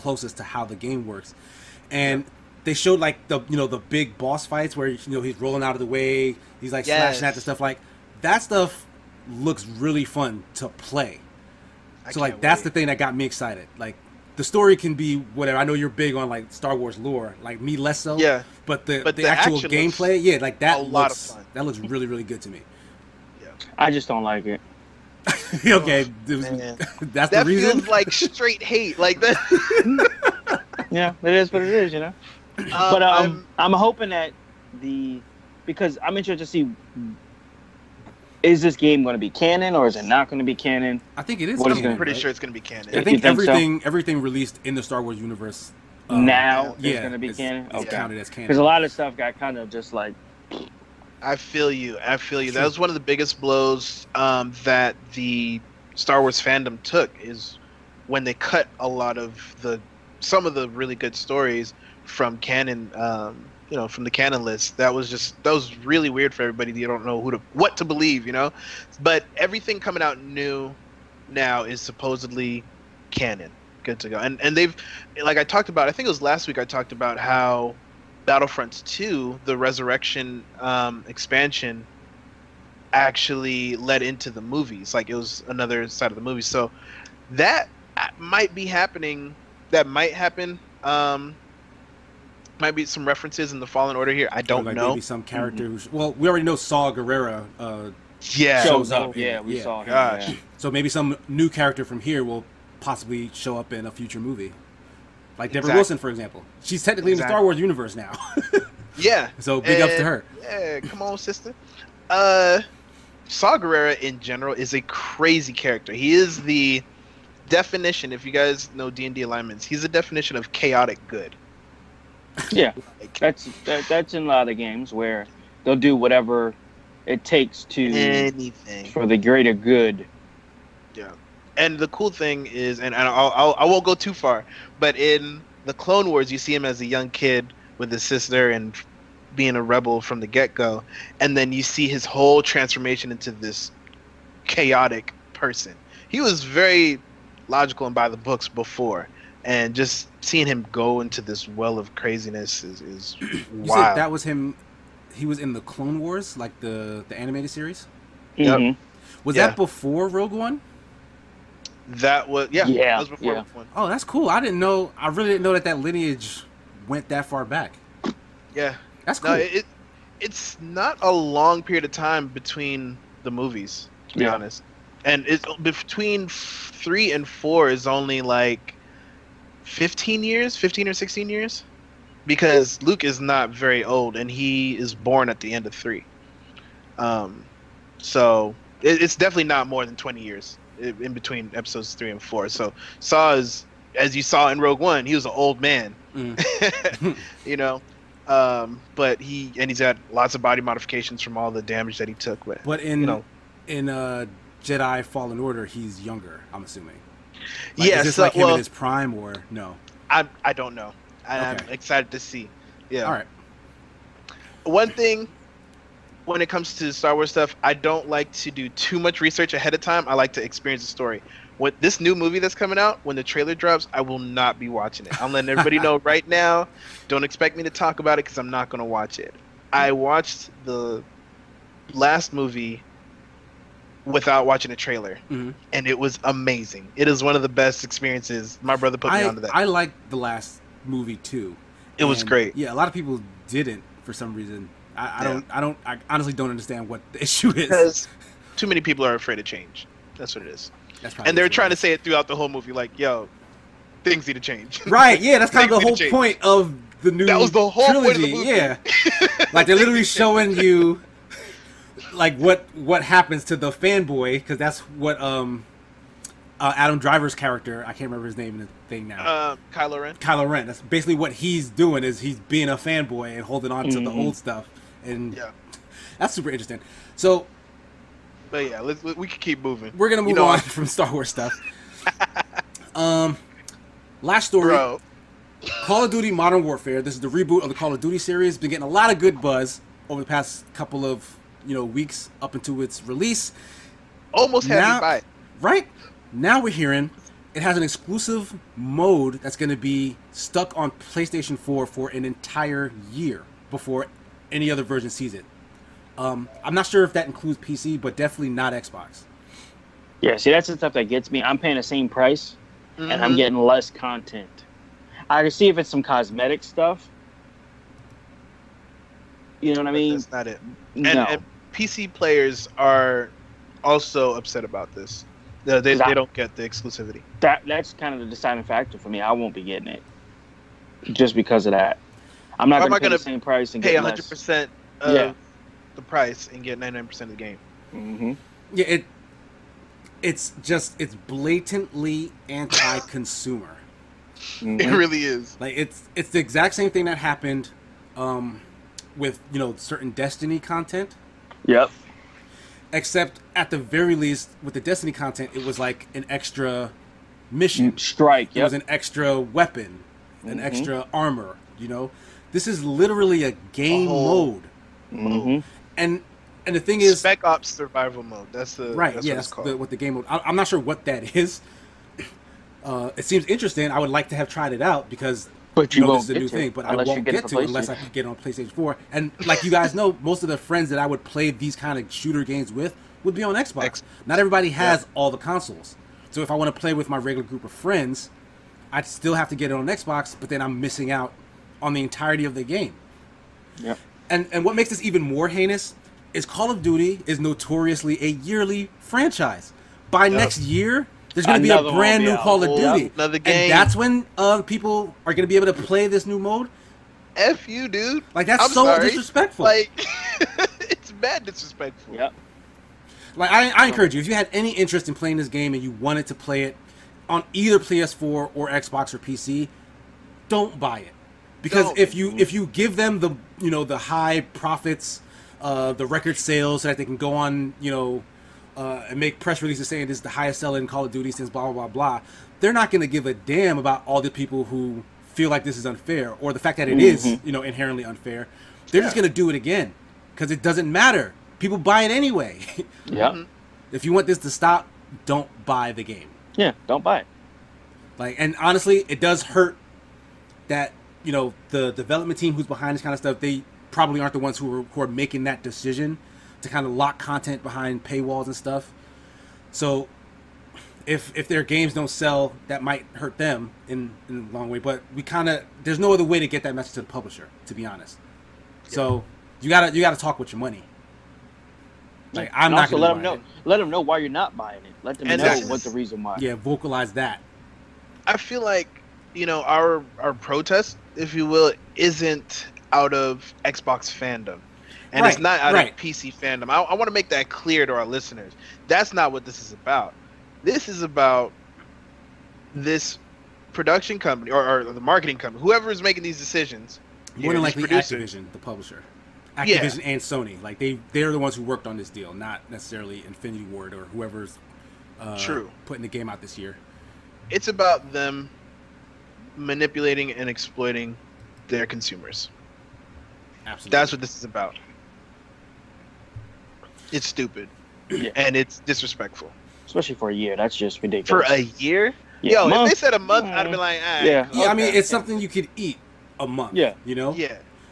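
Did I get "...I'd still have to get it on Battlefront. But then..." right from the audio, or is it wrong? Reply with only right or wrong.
wrong.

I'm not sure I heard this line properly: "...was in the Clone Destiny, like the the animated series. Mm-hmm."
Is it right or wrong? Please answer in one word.
wrong.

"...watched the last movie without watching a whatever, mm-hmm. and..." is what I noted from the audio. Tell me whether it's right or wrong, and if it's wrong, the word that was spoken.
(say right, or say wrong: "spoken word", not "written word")
wrong: "trailer", not "whatever".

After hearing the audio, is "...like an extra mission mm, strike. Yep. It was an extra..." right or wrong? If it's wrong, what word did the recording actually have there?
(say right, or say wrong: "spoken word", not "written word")
right.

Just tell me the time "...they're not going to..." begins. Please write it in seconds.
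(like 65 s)
432 s.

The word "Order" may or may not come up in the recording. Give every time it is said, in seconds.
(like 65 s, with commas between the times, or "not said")
93 s, 205 s.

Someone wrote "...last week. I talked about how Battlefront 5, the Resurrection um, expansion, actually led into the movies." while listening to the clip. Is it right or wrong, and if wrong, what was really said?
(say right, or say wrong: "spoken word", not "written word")
wrong: "2", not "5".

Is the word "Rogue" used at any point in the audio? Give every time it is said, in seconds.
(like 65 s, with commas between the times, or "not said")
160 s, 194 s.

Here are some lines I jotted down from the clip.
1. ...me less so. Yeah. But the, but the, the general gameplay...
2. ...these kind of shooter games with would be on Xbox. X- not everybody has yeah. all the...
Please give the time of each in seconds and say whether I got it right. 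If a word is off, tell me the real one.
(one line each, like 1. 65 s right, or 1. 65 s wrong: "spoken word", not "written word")
1. 17 s wrong: "actual", not "general"
2. 381 s right.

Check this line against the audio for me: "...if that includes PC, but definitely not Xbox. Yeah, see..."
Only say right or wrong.
right.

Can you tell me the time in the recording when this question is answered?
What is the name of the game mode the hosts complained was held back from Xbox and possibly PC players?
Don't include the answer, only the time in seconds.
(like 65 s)
367 s.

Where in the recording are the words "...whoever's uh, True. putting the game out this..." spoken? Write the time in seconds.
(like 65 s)
504 s.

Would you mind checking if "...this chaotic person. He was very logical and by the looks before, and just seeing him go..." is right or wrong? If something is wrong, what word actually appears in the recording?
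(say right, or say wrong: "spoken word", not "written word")
wrong: "books", not "looks".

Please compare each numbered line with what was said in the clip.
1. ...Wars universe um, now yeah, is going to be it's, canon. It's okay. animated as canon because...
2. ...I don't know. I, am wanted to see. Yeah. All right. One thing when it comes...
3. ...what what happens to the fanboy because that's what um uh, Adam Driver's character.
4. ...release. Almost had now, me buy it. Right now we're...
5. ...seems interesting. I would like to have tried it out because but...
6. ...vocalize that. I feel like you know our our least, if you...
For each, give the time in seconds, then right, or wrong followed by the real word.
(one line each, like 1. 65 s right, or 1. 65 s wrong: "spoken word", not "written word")
1. 45 s wrong: "counted", not "animated"
2. 210 s wrong: "excited", not "wanted"
3. 262 s right
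4. 293 s right
5. 373 s right
6. 476 s wrong: "protest", not "least".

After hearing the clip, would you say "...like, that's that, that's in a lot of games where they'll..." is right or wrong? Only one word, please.
right.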